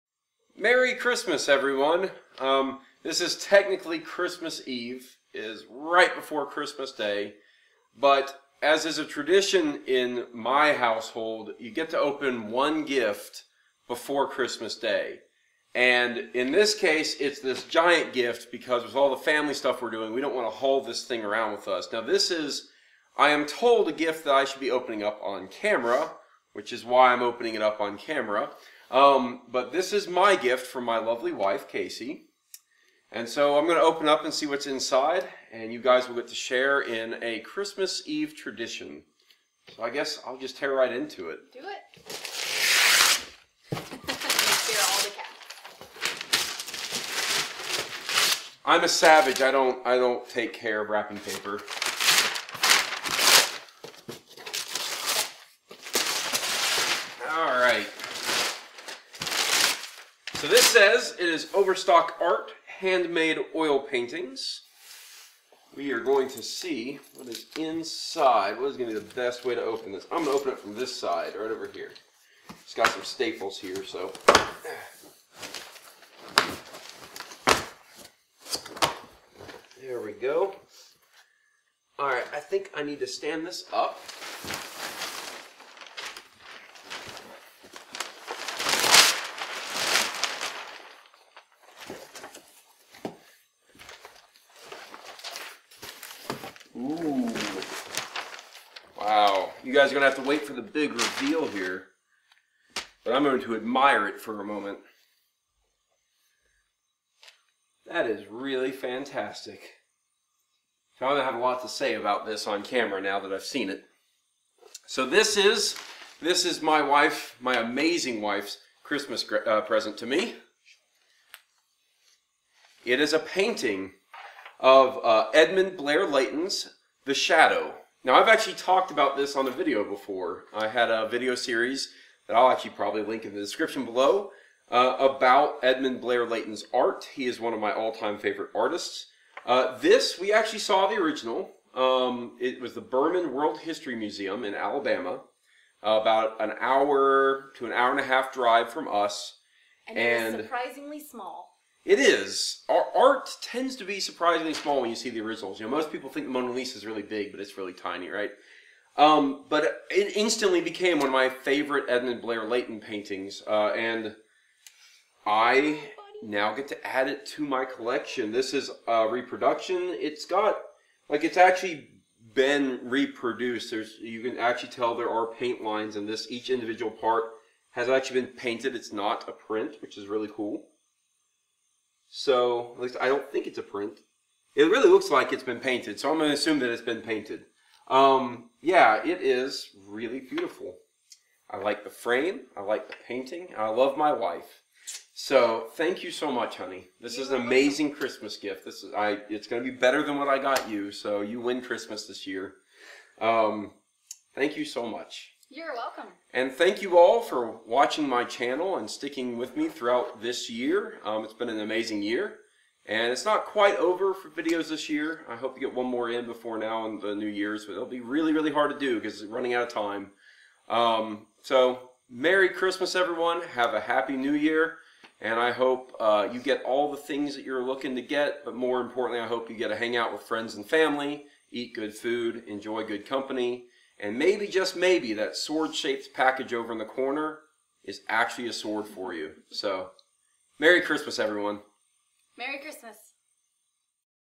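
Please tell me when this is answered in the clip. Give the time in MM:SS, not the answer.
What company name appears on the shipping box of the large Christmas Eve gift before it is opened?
01:01.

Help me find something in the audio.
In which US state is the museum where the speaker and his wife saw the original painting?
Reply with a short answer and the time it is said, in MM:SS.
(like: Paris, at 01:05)
Alabama, at 02:24.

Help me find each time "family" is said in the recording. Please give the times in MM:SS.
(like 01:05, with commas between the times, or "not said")
00:19, 03:50.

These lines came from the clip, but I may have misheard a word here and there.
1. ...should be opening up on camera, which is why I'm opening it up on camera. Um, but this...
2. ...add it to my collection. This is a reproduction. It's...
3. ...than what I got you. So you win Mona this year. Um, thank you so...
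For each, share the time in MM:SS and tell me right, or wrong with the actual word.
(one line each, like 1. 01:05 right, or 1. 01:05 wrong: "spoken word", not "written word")
1. 00:24 right
2. 02:46 right
3. 03:20 wrong: "Christmas", not "Mona".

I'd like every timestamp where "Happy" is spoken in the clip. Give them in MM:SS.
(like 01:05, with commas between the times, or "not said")
03:43.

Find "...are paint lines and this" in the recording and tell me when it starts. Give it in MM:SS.
02:55.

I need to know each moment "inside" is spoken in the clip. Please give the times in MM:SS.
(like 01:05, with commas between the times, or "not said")
00:34, 01:07.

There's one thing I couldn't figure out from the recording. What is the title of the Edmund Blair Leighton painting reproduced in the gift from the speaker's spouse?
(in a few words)
The Shadow.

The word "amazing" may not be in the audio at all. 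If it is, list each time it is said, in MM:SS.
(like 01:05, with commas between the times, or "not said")
01:57, 03:17, 03:31.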